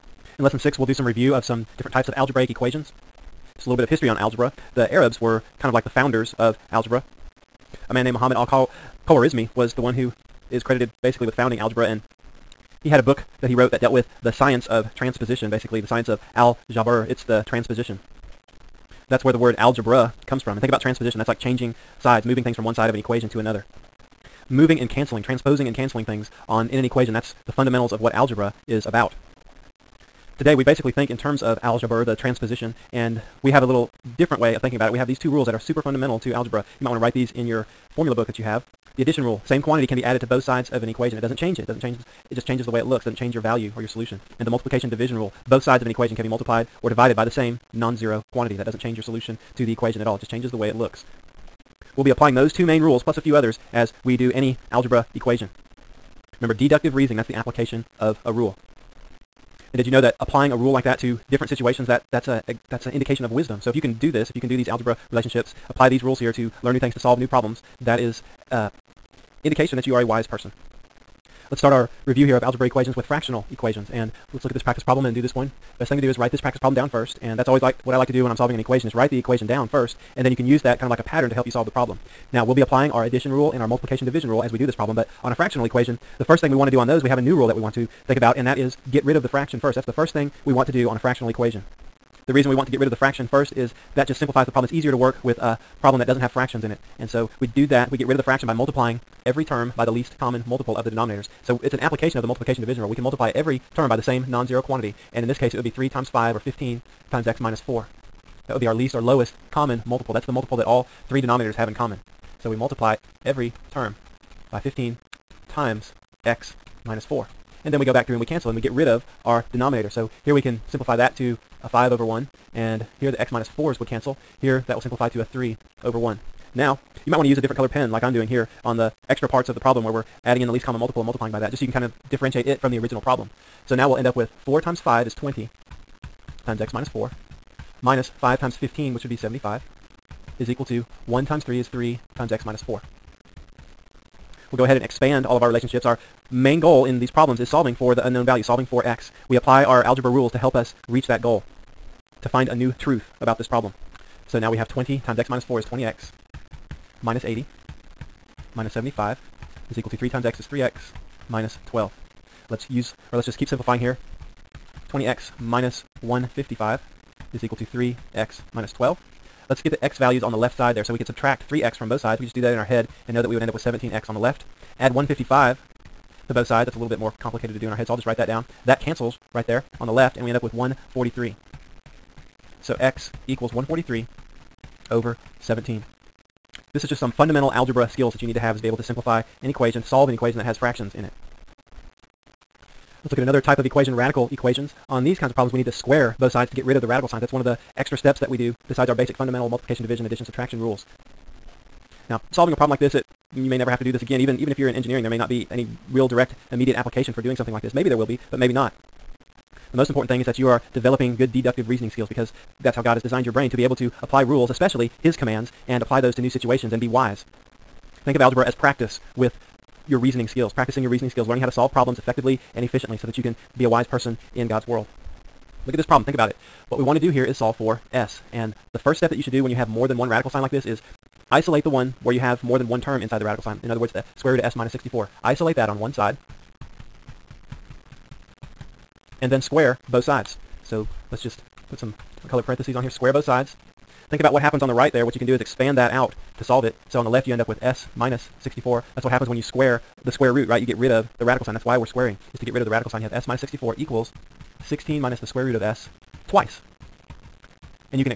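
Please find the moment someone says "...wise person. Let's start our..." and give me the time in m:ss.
1:10.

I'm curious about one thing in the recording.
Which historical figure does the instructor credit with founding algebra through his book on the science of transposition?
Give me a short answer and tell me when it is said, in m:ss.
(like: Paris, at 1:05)
Muhammad al-Khwarizmi, at 0:08.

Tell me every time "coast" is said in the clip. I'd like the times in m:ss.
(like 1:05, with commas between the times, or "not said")
not said.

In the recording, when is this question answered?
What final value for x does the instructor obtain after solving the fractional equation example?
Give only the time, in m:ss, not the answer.
3:03.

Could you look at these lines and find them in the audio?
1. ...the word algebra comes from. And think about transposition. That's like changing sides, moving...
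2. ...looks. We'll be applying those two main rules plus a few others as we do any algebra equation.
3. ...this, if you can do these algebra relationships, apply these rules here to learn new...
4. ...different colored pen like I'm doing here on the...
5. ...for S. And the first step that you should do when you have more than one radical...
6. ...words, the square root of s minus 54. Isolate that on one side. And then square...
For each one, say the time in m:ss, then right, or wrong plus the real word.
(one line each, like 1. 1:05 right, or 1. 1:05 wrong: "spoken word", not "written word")
1. 0:19 right
2. 0:50 right
3. 1:04 right
4. 2:07 right
5. 3:47 right
6. 3:53 wrong: "64", not "54".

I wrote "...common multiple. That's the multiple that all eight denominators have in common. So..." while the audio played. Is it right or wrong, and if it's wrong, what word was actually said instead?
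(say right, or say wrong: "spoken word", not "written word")
wrong: "three", not "eight".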